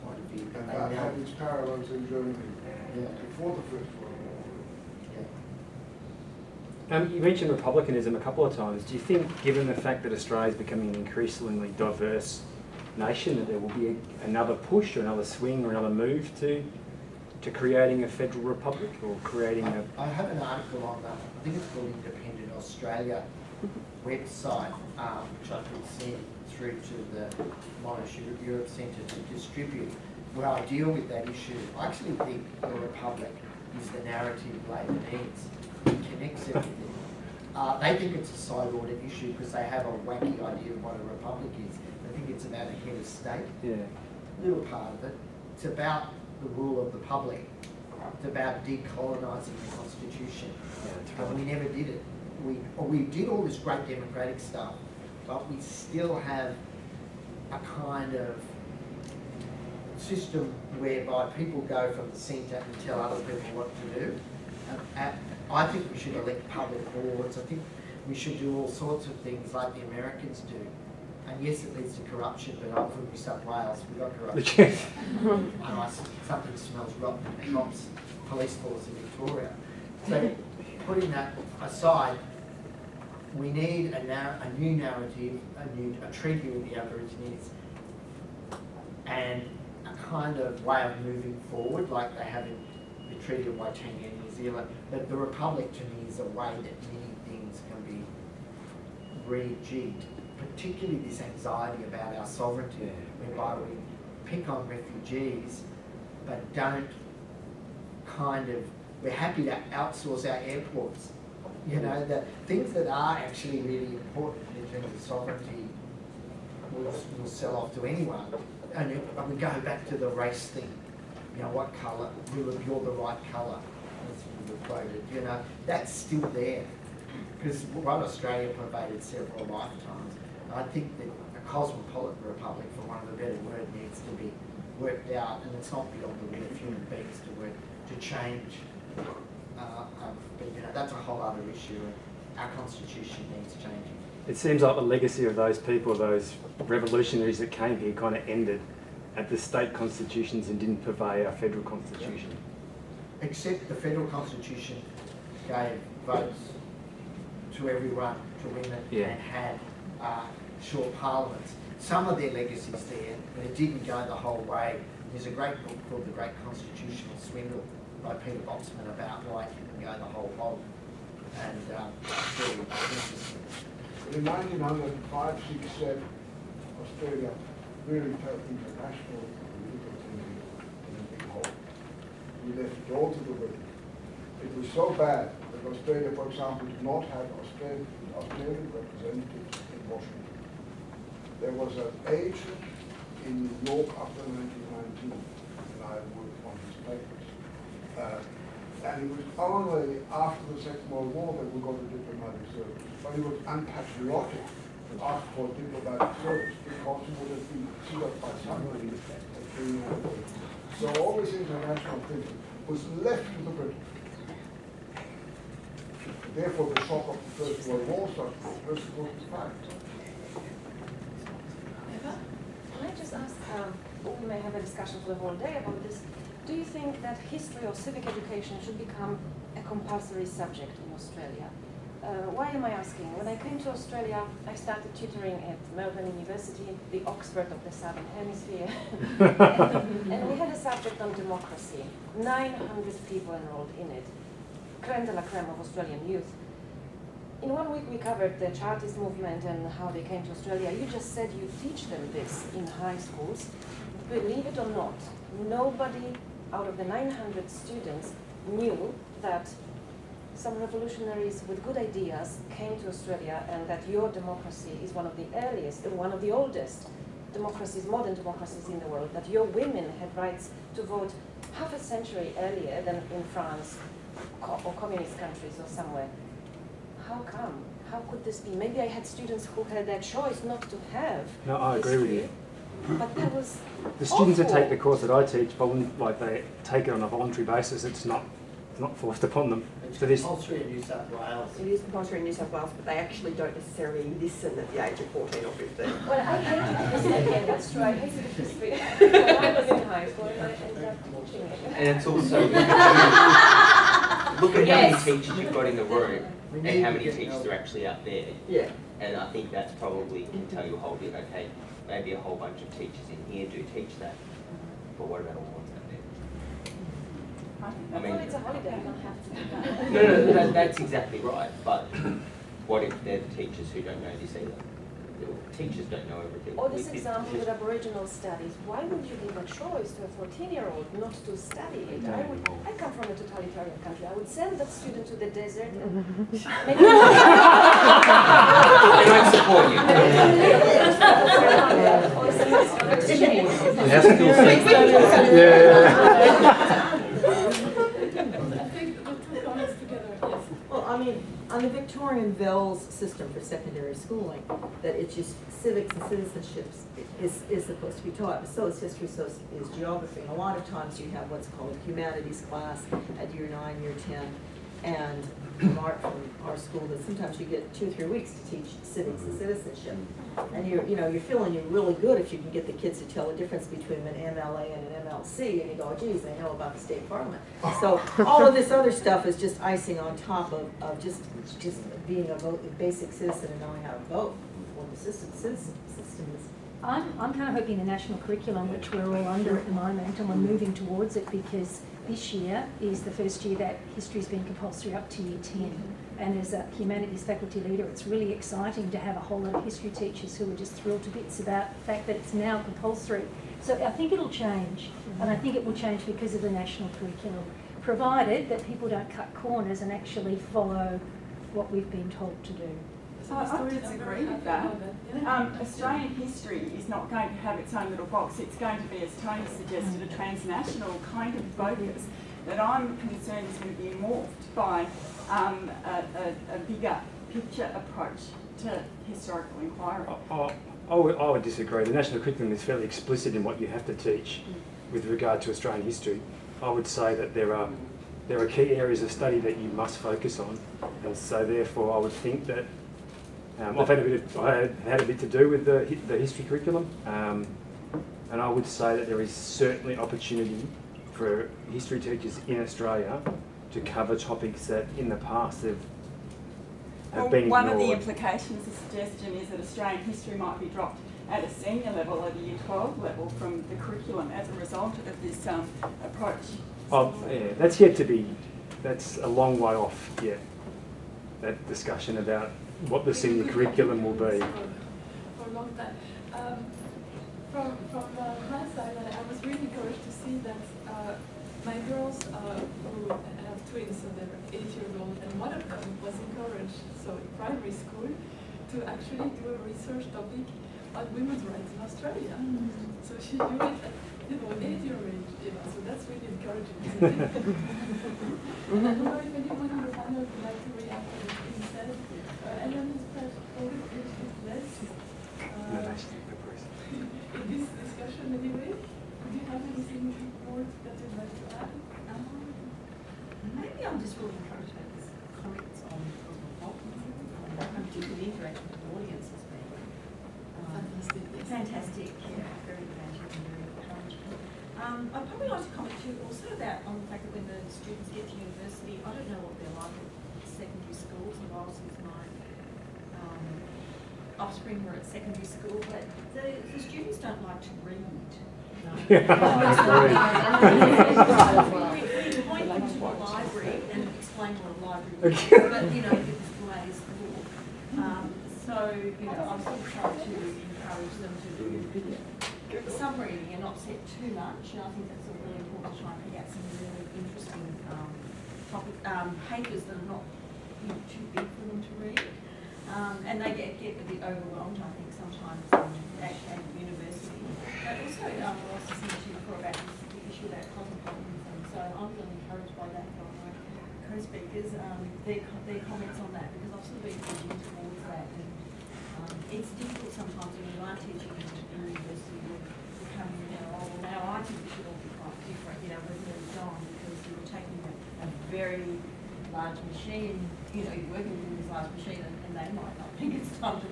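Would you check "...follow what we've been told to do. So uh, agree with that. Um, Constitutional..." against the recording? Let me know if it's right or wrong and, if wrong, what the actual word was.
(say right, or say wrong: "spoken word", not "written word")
wrong: "Australian", not "Constitutional".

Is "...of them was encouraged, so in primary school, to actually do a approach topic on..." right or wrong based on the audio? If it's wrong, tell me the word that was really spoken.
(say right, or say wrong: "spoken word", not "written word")
wrong: "research", not "approach".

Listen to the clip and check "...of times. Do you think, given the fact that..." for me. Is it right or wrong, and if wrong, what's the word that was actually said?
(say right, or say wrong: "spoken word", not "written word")
right.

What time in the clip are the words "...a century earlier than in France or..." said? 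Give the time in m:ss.
4:31.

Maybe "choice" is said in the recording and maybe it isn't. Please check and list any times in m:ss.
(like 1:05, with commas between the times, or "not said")
4:40, 5:29.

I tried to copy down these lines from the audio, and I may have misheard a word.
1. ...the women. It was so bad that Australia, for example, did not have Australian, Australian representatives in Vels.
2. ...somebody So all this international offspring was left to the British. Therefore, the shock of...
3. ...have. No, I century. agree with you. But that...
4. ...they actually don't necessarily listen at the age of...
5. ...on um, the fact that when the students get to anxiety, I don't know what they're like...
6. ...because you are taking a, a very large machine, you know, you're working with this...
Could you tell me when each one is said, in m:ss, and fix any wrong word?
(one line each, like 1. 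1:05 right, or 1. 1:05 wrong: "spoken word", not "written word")
1. 3:03 wrong: "Washington", not "Vels"
2. 3:28 wrong: "thinking", not "offspring"
3. 4:40 wrong: "history", not "century"
4. 4:52 right
5. 8:46 wrong: "university", not "anxiety"
6. 9:46 right.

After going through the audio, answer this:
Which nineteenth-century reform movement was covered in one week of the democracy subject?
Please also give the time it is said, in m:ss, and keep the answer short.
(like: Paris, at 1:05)
Chartist movement, at 4:08.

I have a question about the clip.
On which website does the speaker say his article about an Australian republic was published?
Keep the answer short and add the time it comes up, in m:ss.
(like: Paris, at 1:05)
Independent Australia, at 0:22.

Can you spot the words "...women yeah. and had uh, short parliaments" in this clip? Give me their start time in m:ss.
2:38.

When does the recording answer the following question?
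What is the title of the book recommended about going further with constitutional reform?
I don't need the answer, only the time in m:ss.
2:46.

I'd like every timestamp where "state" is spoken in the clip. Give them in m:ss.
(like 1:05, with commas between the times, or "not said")
0:43, 2:29, 6:16.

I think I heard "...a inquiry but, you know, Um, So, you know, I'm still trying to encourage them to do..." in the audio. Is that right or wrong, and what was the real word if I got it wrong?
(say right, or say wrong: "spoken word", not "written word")
wrong: "library", not "inquiry".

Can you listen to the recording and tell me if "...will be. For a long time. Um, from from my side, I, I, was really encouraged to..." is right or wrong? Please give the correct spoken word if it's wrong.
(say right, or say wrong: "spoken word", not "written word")
right.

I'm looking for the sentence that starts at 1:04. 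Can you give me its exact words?
And, and uh, I think we should elect public boards.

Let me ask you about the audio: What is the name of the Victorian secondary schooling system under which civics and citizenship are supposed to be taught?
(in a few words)
Vels.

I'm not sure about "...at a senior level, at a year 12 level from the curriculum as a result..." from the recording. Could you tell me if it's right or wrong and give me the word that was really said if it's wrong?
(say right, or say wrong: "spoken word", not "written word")
right.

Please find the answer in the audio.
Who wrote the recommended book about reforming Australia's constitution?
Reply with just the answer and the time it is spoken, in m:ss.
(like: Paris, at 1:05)
Peter Botsman, at 2:48.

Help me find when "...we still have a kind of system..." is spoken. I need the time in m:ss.
0:55.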